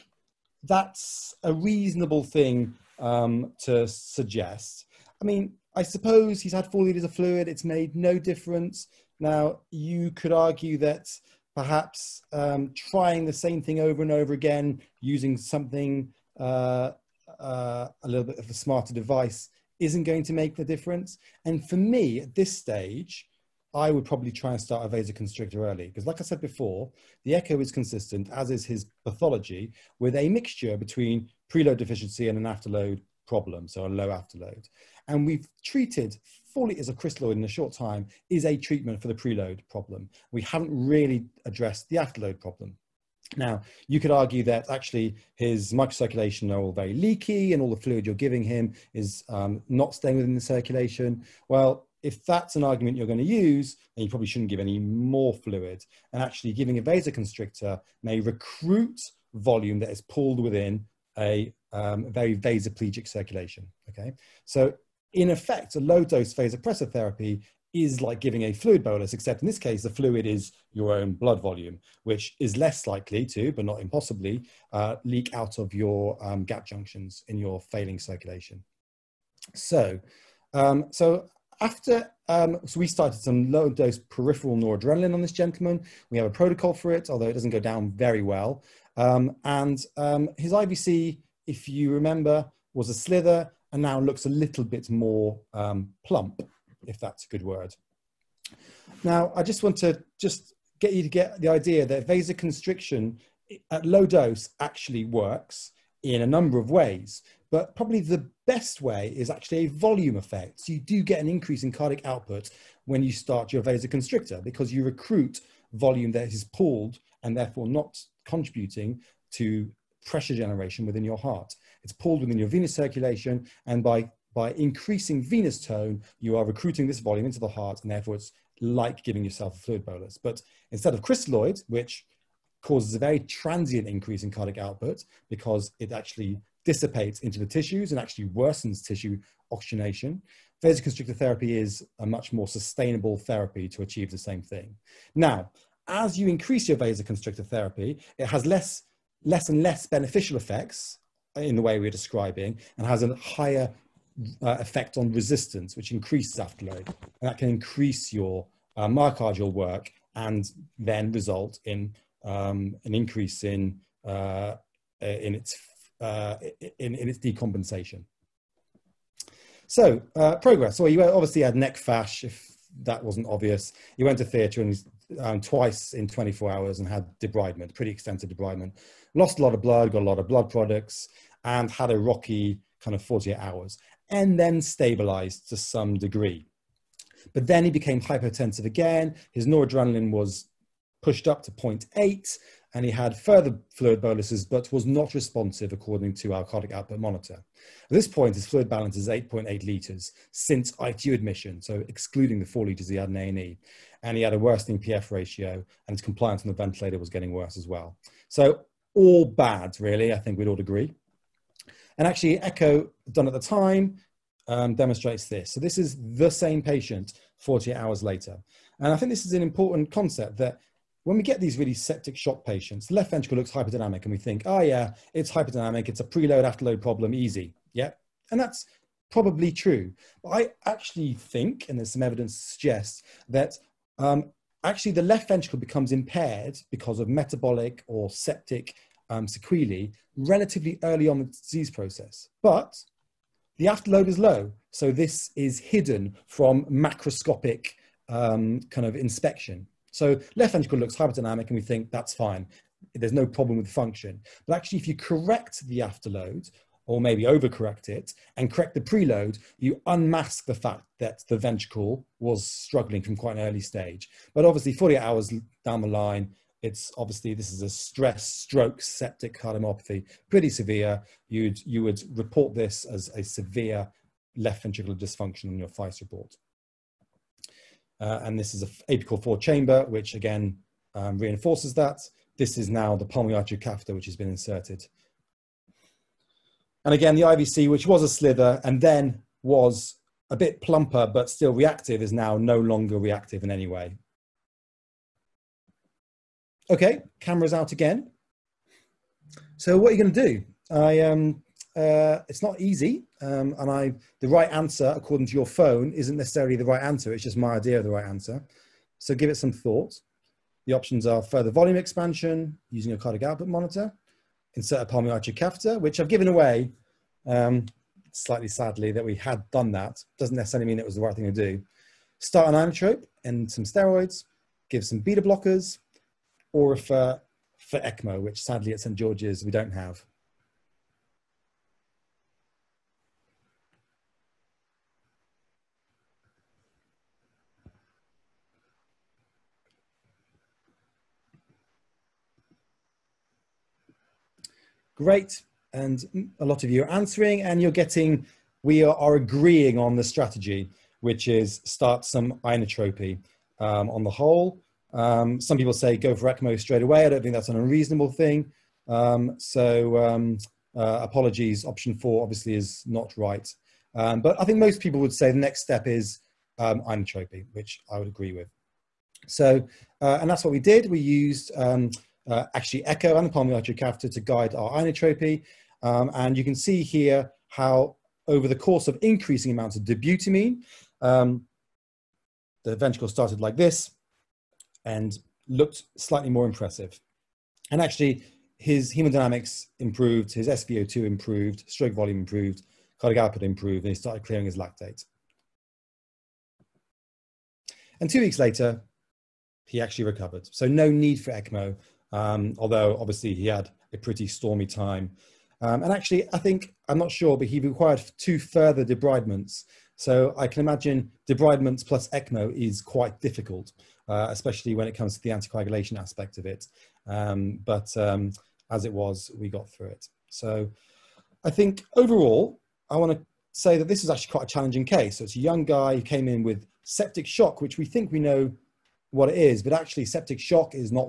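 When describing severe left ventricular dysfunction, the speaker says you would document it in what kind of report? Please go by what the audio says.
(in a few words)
FICE report.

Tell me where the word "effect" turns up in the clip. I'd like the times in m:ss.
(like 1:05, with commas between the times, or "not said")
1:05, 1:50, 2:30, 2:34.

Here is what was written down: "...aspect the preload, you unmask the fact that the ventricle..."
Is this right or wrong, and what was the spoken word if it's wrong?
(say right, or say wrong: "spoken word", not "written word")
wrong: "correct", not "aspect".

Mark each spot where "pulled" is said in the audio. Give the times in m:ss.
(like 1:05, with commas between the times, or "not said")
1:00, 1:56, 2:01.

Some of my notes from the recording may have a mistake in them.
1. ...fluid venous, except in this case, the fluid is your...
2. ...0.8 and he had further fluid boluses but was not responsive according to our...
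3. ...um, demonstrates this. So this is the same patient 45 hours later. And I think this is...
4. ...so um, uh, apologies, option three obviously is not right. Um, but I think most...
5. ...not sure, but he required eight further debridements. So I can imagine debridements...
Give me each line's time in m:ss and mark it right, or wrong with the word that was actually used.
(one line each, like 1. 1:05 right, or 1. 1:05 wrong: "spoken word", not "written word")
1. 1:08 wrong: "bolus", not "venous"
2. 3:11 right
3. 3:34 wrong: "48", not "45"
4. 5:59 wrong: "four", not "three"
5. 6:46 wrong: "two", not "eight".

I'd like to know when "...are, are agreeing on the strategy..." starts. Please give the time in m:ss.
5:48.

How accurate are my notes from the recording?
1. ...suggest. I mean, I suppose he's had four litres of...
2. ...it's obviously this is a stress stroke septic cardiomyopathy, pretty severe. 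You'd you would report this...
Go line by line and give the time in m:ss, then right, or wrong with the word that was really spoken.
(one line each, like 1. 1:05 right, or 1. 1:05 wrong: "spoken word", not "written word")
1. 0:03 right
2. 4:26 right.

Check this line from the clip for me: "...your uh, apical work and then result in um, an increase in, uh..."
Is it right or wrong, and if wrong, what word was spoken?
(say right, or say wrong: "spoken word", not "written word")
wrong: "myocardial", not "apical".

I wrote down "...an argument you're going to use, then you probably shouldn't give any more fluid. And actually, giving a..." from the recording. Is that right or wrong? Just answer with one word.
right.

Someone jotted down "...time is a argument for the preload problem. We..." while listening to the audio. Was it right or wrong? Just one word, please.
wrong.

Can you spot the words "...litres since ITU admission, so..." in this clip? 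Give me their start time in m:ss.
3:19.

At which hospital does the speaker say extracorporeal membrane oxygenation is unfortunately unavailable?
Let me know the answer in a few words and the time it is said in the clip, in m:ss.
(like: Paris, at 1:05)
St. George's, at 5:28.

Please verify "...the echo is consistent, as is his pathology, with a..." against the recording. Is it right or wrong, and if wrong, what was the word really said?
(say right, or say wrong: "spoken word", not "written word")
right.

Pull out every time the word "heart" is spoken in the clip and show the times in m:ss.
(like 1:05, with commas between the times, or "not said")
2:01, 2:07.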